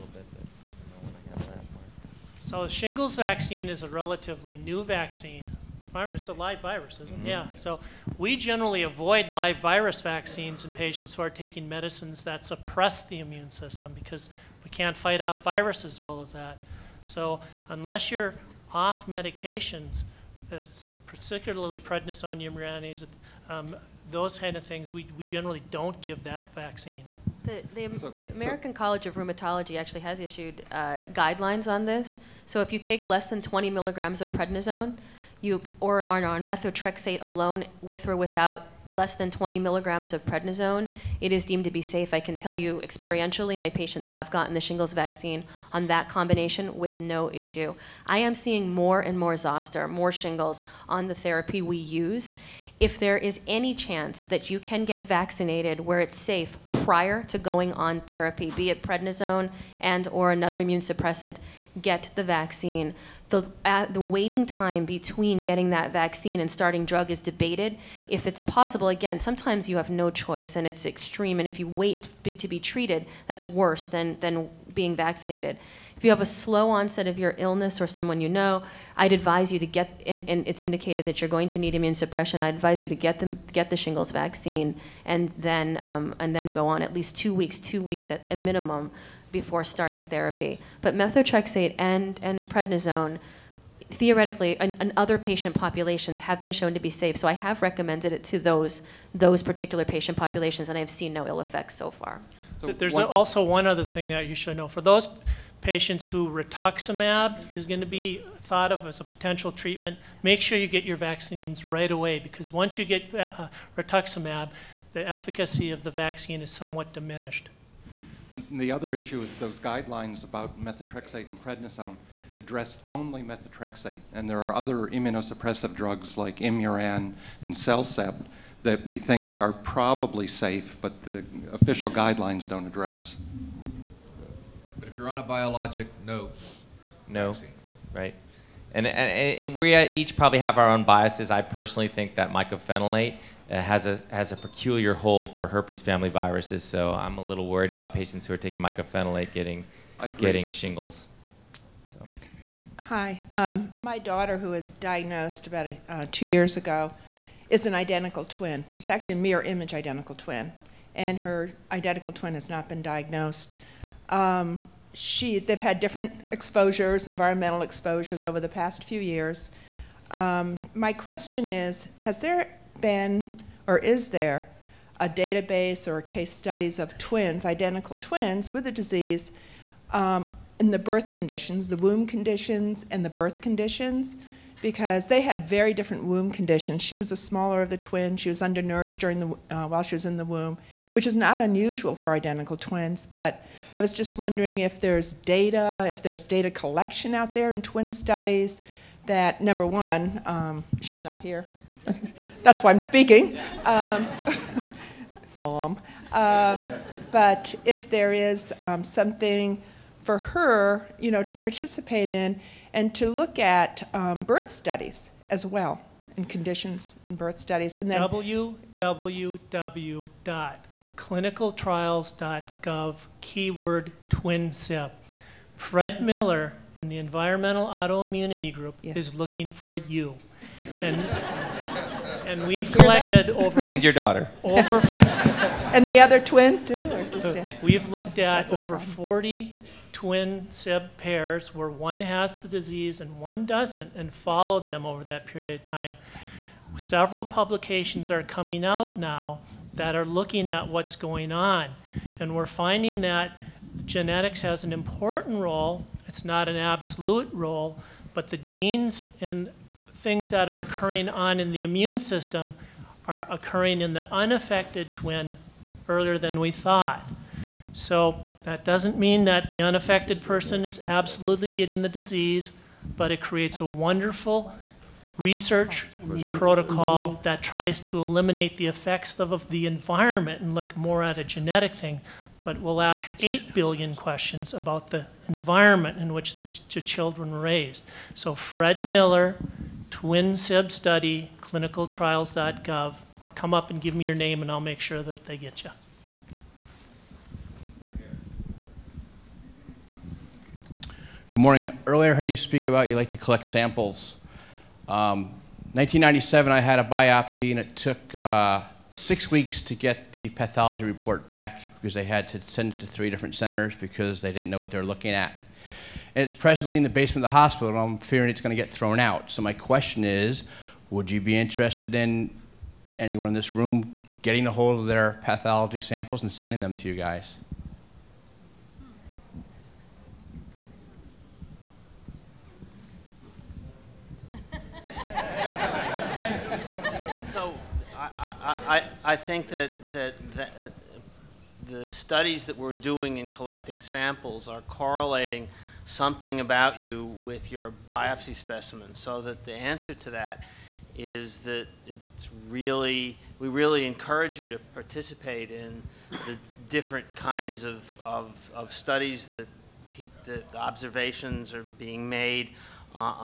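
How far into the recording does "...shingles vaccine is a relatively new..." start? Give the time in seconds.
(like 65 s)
2 s.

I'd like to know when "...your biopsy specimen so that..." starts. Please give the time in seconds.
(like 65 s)
347 s.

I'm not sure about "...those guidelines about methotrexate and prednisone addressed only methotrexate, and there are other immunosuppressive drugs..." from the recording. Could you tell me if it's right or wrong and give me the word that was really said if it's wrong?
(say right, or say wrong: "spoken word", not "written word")
right.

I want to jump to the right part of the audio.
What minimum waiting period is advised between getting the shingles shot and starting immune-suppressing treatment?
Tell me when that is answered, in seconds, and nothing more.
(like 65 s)
87 s.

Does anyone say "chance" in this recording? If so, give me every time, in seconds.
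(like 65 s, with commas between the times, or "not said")
53 s.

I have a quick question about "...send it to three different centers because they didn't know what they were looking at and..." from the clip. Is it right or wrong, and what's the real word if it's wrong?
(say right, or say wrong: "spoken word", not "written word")
right.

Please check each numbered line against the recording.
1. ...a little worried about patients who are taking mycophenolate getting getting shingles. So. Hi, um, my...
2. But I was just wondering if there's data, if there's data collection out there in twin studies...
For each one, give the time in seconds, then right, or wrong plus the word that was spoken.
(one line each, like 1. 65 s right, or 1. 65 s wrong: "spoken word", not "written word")
1. 147 s right
2. 193 s right.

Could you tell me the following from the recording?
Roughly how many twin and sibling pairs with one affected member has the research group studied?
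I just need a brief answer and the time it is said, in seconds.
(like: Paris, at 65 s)
over 40, at 238 s.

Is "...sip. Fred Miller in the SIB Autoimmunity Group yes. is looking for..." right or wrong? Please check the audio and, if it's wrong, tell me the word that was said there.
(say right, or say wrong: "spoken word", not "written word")
wrong: "Environmental", not "SIB".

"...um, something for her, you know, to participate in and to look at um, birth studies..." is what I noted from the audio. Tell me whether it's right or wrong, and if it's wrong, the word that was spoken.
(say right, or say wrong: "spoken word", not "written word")
right.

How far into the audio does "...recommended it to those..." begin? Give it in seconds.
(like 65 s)
97 s.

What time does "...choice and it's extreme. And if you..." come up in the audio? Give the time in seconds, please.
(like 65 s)
70 s.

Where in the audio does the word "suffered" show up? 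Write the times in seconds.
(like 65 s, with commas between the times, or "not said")
not said.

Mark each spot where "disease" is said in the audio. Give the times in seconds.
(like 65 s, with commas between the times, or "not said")
178 s, 242 s, 271 s.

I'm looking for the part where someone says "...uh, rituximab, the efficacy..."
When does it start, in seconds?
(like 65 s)
113 s.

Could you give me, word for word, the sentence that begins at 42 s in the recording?
I can tell you experientially, my patients have gotten the shingles vaccine on that combination with no issue.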